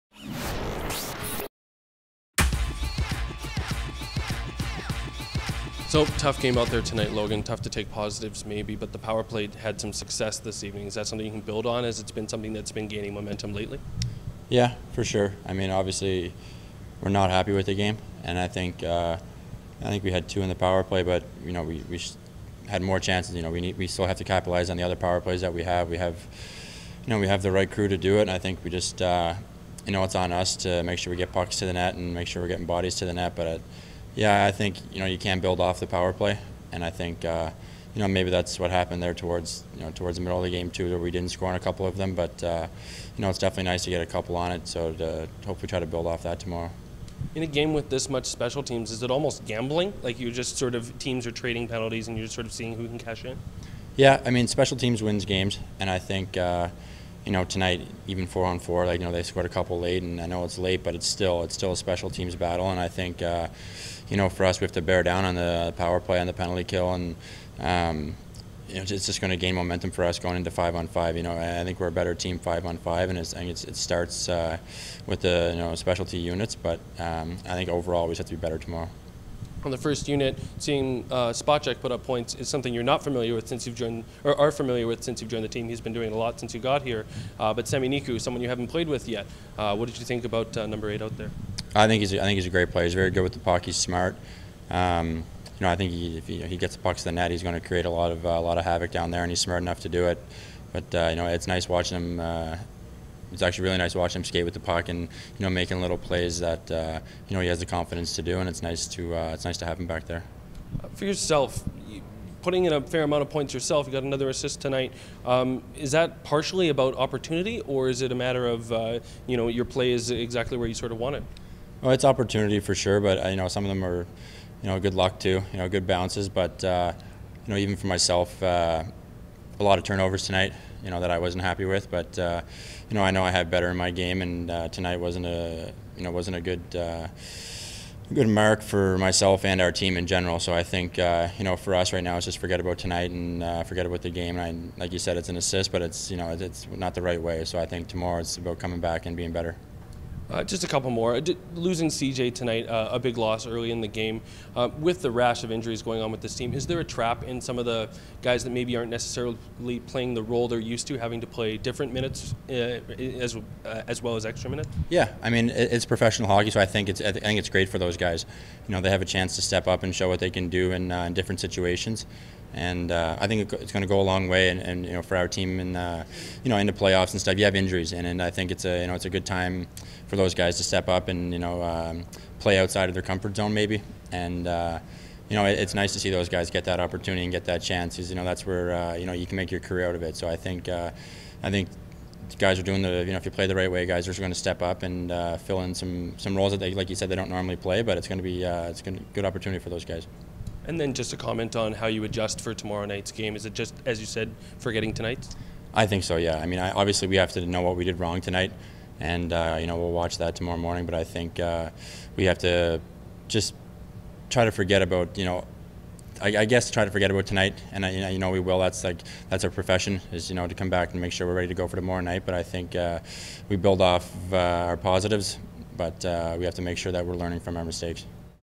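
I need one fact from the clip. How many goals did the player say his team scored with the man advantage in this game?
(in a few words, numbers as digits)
2.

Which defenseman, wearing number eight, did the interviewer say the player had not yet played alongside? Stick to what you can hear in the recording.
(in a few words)
Sami Niku.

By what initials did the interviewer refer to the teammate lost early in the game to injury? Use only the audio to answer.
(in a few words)
CJ.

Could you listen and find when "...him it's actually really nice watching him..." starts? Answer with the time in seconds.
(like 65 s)
101 s.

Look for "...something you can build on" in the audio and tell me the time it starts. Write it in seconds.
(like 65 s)
11 s.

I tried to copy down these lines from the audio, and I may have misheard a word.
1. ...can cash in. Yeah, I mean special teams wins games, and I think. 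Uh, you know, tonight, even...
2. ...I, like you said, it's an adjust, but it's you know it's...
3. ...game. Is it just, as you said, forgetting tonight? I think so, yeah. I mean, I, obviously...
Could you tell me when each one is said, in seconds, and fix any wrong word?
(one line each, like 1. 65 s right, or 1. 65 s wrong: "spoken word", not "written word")
1. 52 s right
2. 144 s wrong: "assist", not "adjust"
3. 203 s right.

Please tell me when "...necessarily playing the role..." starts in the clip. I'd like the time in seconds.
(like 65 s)
158 s.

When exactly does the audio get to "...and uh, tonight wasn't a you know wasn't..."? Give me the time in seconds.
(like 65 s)
134 s.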